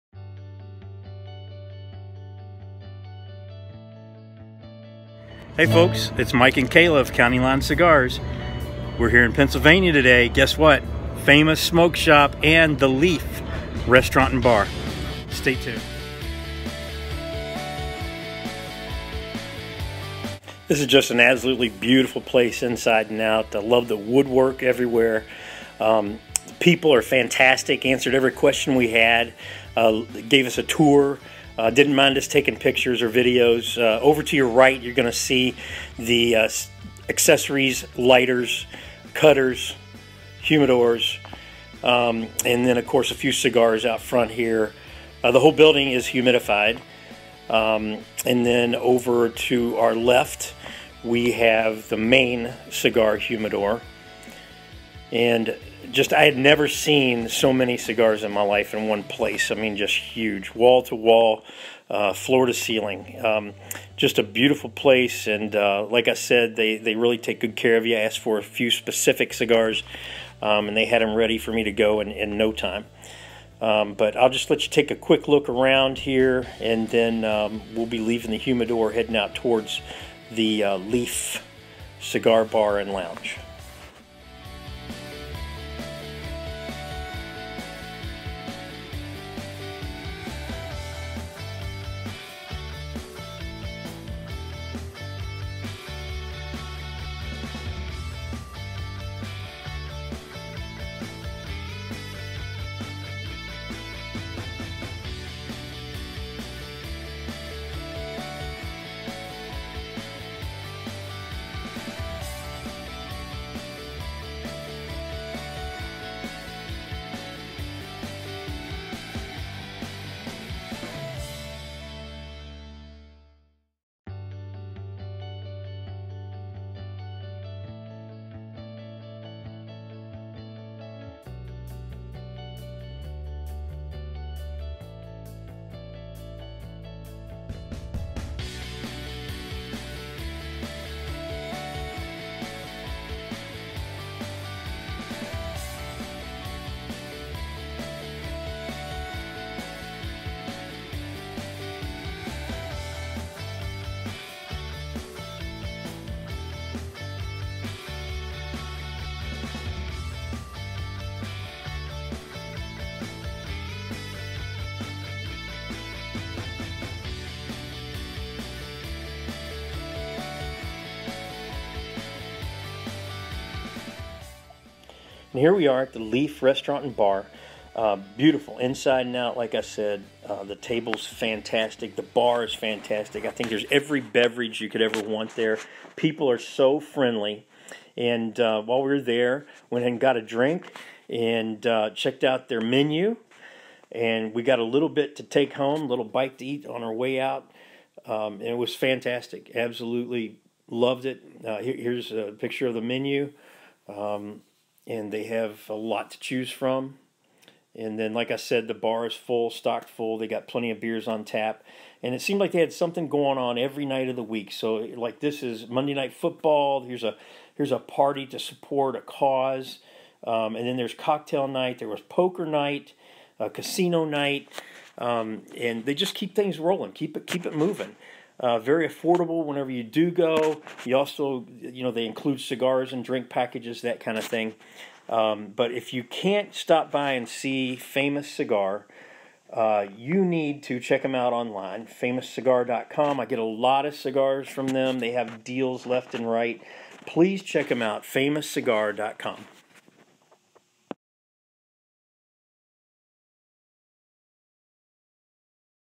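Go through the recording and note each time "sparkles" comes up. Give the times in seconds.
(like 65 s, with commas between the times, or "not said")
not said.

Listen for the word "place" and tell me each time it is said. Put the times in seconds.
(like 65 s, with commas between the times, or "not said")
22 s, 59 s, 64 s.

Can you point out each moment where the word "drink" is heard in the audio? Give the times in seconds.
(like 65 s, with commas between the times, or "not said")
190 s, 233 s.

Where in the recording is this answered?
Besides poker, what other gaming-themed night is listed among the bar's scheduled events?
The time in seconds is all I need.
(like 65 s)
223 s.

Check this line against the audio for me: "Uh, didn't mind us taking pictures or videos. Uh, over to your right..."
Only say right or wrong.
right.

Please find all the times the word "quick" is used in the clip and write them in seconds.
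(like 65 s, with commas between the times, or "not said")
74 s.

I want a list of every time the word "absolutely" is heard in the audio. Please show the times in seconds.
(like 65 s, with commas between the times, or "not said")
21 s, 199 s.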